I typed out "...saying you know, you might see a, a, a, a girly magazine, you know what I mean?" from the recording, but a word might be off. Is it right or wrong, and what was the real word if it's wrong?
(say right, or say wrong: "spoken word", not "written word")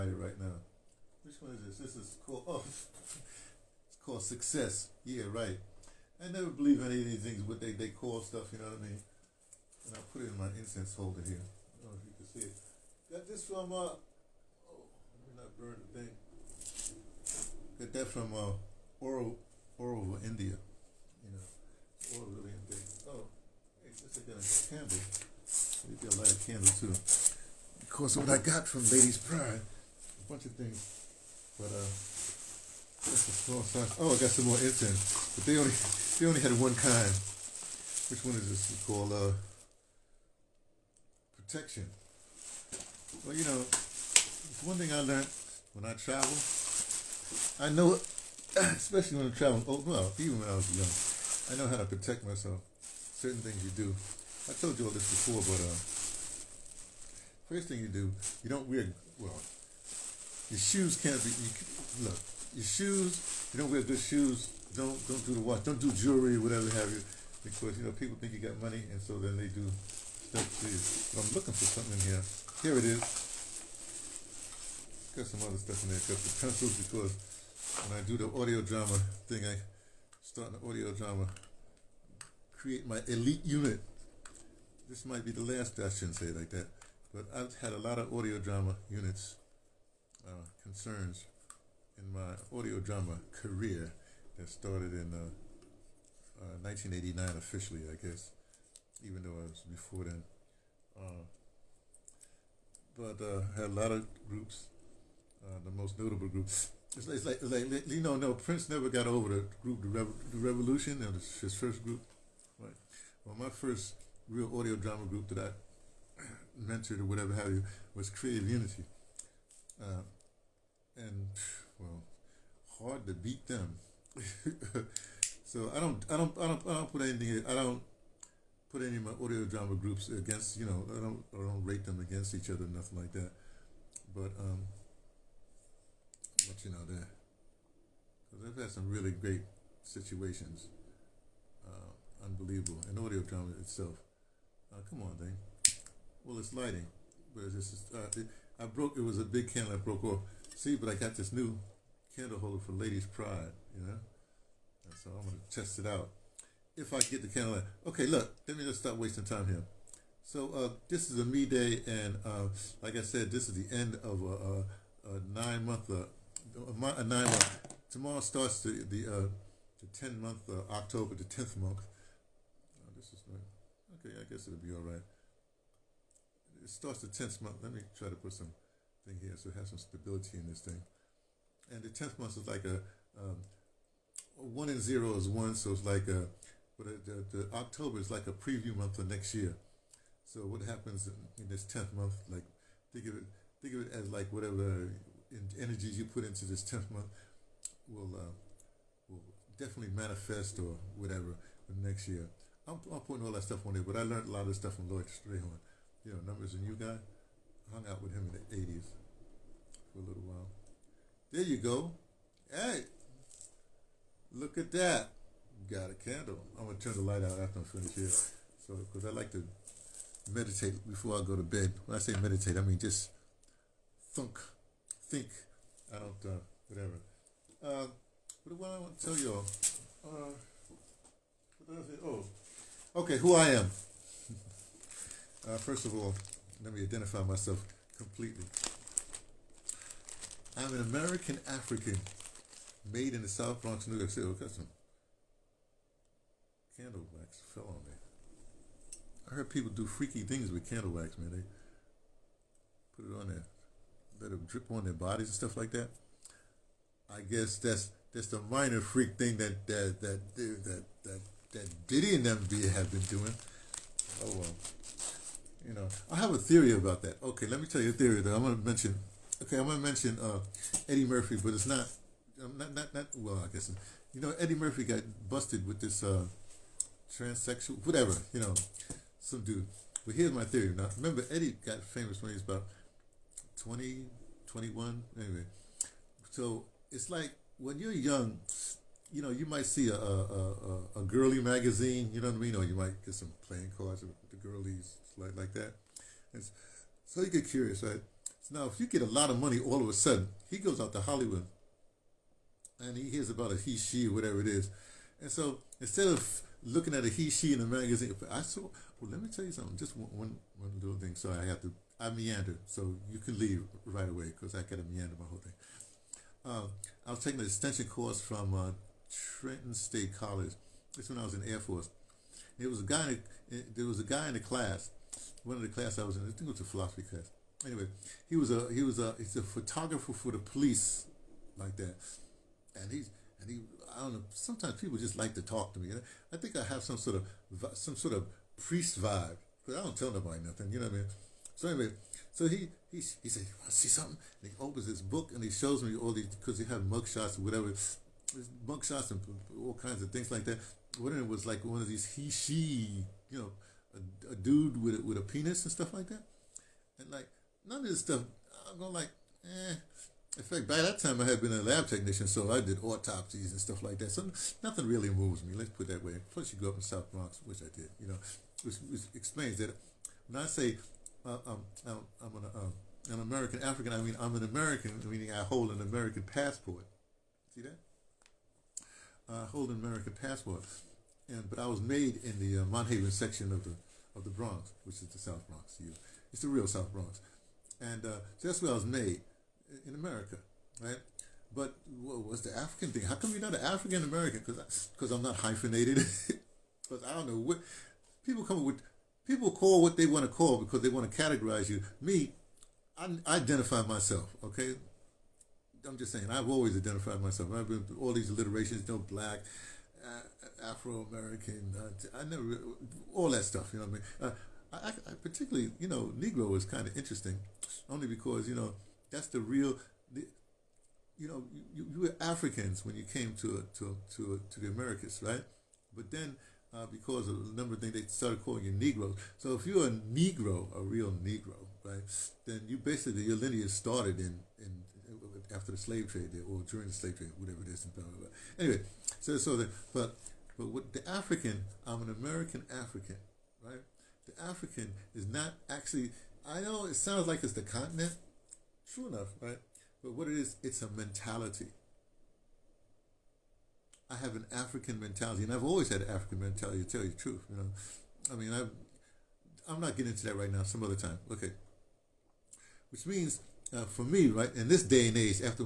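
wrong: "young", not "saying".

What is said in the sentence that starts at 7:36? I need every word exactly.
To tell you the truth, you know, I mean, I, I'm not getting into that right now.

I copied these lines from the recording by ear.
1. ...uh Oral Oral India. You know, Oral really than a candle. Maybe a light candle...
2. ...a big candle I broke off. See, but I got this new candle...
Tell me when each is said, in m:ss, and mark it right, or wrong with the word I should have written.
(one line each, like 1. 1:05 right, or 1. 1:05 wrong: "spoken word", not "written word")
1. 0:18 right
2. 2:29 right.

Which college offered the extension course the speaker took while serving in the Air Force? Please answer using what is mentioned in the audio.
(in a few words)
Trenton State College.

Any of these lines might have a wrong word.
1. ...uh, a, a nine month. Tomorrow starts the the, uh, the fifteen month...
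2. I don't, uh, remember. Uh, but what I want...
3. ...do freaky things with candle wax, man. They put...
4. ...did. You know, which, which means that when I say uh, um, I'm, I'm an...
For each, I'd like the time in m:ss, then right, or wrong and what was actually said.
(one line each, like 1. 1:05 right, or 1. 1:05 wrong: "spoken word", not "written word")
1. 2:45 wrong: "ten", not "fifteen"
2. 3:45 wrong: "whatever", not "remember"
3. 4:09 right
4. 6:07 wrong: "explains", not "means".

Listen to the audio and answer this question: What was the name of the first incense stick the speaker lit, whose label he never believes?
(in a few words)
Success.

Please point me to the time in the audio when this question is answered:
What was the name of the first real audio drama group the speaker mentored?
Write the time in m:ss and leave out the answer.
1:58.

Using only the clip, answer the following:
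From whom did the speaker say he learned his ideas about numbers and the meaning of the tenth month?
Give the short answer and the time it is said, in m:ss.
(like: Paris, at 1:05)
Lloyd Strayhorn, at 3:24.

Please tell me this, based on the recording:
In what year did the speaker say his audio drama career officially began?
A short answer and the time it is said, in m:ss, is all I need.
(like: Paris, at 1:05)
1989, at 1:36.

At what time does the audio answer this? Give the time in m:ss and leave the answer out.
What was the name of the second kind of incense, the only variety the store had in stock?
0:41.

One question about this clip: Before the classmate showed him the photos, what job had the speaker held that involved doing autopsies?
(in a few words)
Lab technician.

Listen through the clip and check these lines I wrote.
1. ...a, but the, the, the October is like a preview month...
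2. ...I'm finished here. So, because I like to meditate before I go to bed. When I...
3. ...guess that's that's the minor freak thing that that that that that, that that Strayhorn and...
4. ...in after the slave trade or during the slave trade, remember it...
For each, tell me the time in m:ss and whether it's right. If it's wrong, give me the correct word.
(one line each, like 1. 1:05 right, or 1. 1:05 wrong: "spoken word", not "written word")
1. 3:06 right
2. 3:37 right
3. 4:17 wrong: "Diddy", not "Strayhorn"
4. 7:14 wrong: "whatever", not "remember".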